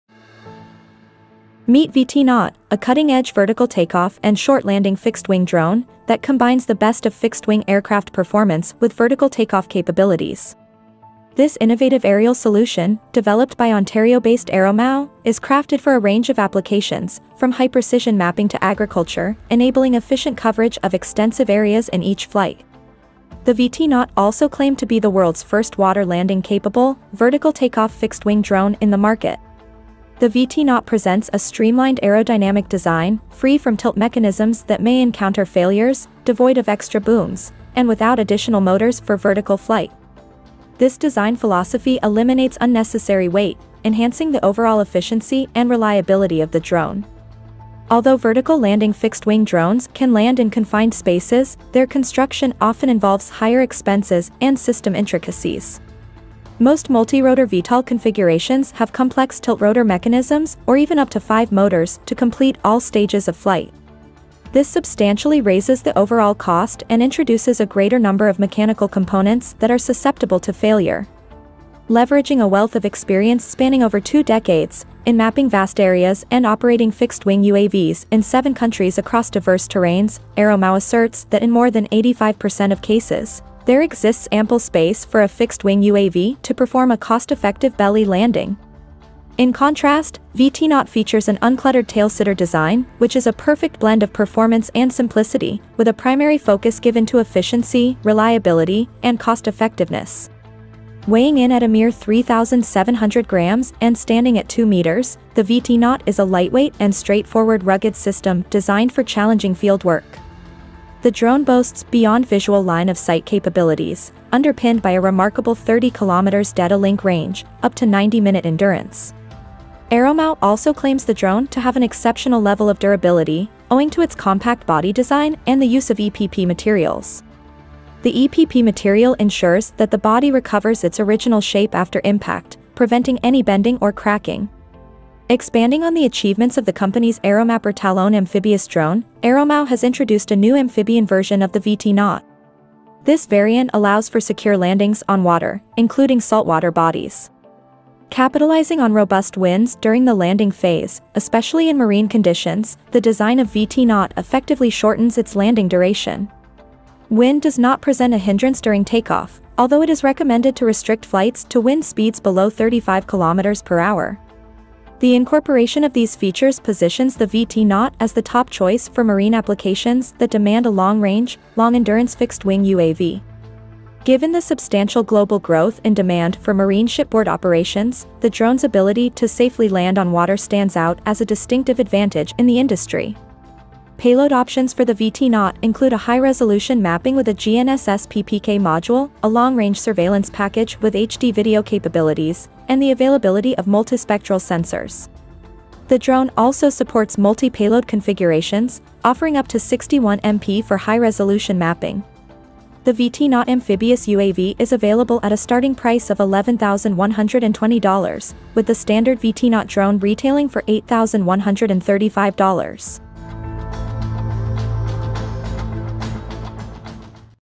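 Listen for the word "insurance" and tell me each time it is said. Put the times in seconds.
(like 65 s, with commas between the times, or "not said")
not said.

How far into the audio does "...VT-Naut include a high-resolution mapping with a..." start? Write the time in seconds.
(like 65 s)
184 s.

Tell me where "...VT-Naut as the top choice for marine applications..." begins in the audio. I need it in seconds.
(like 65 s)
167 s.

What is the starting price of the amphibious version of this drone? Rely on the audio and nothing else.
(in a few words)
$11,120.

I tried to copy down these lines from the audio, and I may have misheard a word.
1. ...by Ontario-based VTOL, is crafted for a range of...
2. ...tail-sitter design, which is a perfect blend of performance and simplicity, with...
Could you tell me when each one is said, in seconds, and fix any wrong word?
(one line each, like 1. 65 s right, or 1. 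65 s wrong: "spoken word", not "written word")
1. 13 s wrong: "Aeromao", not "VTOL"
2. 91 s right.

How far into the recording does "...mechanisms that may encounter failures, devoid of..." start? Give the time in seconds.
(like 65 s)
33 s.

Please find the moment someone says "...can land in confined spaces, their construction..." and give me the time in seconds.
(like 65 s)
49 s.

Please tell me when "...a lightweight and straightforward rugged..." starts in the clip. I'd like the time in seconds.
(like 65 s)
106 s.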